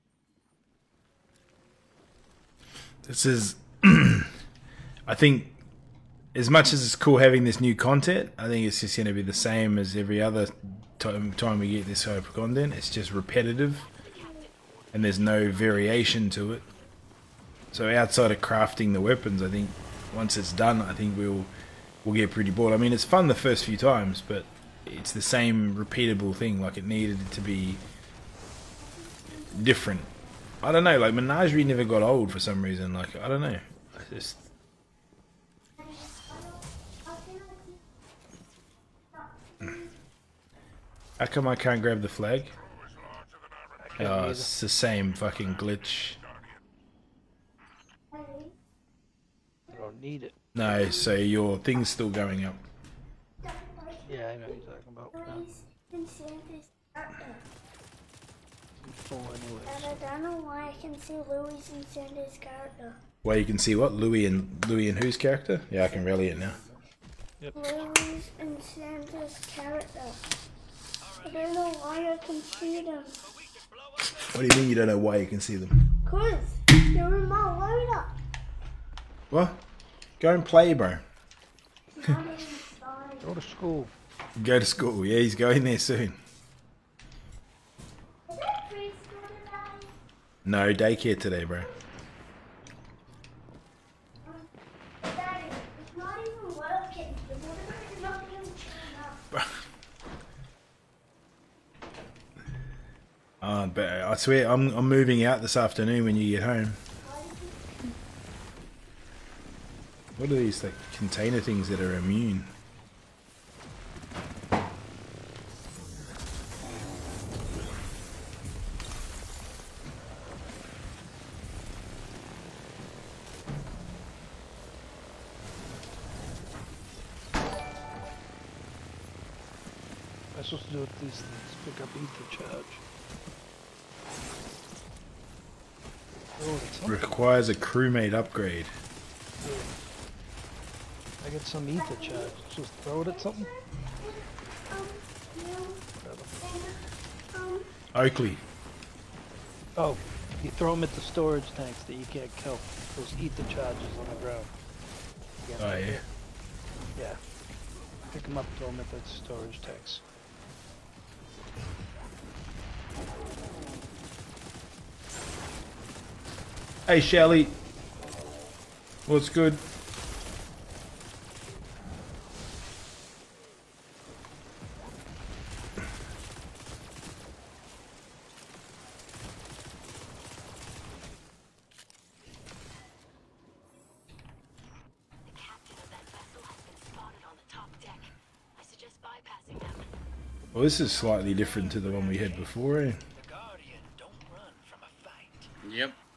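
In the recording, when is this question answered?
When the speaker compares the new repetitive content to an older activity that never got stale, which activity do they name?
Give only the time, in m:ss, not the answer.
0:31.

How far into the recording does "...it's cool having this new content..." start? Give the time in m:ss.
0:06.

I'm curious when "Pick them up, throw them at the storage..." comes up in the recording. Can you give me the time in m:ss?
2:38.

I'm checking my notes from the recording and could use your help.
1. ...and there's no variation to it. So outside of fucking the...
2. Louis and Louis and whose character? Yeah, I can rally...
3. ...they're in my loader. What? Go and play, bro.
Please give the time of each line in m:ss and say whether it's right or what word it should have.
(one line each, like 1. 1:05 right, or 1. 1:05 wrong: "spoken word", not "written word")
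1. 0:14 wrong: "crafting", not "fucking"
2. 1:03 right
3. 1:16 right.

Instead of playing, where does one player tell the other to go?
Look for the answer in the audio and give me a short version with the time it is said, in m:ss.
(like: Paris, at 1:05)
daycare, at 1:30.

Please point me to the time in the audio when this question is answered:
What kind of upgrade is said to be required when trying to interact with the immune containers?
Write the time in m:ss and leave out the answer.
2:17.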